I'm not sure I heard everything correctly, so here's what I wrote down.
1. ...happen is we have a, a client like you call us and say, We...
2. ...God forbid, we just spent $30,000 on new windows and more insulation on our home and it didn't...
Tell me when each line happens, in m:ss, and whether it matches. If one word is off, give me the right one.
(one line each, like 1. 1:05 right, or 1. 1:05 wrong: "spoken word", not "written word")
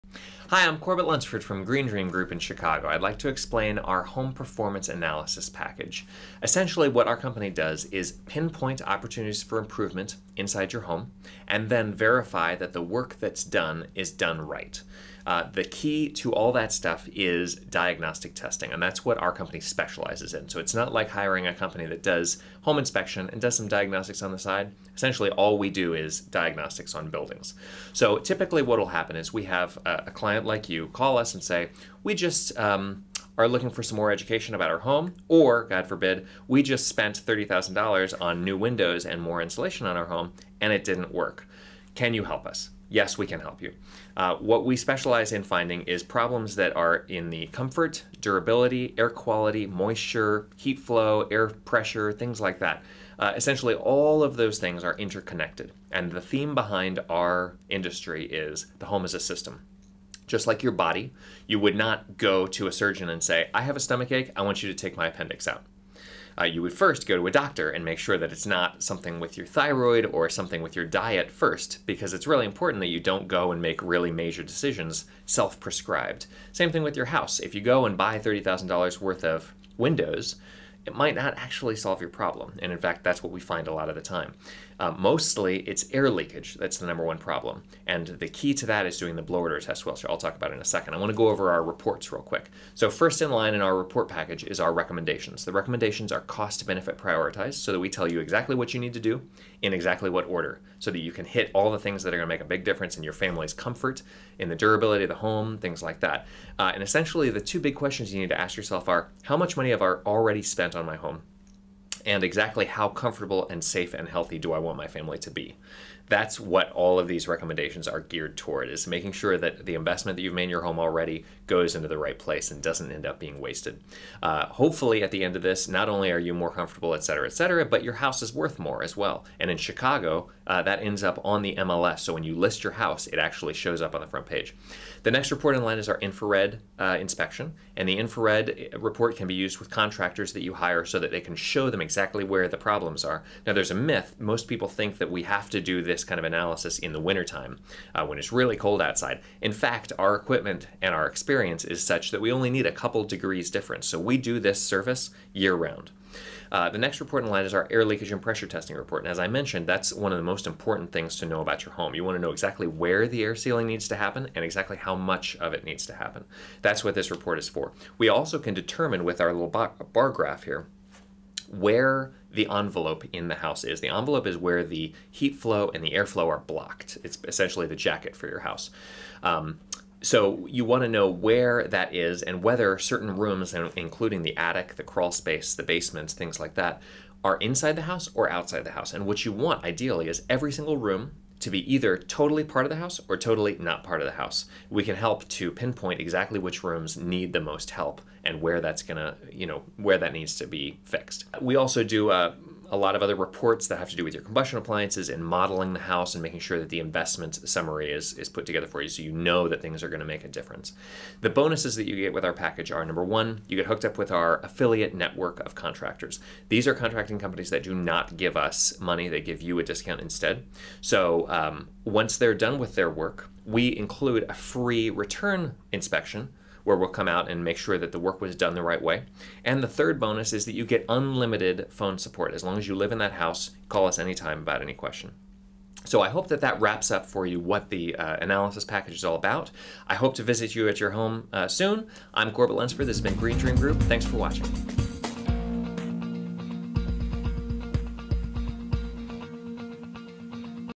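1. 0:28 right
2. 0:35 right.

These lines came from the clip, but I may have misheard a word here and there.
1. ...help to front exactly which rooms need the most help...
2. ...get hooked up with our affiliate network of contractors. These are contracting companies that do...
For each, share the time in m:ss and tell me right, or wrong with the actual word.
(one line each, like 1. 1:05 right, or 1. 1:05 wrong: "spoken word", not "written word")
1. 3:14 wrong: "pinpoint", not "front"
2. 3:33 right.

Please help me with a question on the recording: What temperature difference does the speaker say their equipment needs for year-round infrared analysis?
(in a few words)
A couple degrees.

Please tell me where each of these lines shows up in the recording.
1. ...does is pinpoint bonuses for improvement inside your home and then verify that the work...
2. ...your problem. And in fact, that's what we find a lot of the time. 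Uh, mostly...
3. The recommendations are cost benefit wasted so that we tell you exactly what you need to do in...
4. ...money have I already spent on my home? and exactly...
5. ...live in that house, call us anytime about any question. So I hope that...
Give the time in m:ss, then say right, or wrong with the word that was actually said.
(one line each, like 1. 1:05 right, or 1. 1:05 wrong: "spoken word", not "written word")
1. 0:07 wrong: "opportunities", not "bonuses"
2. 1:22 right
3. 1:35 wrong: "prioritized", not "wasted"
4. 1:49 right
5. 3:52 right.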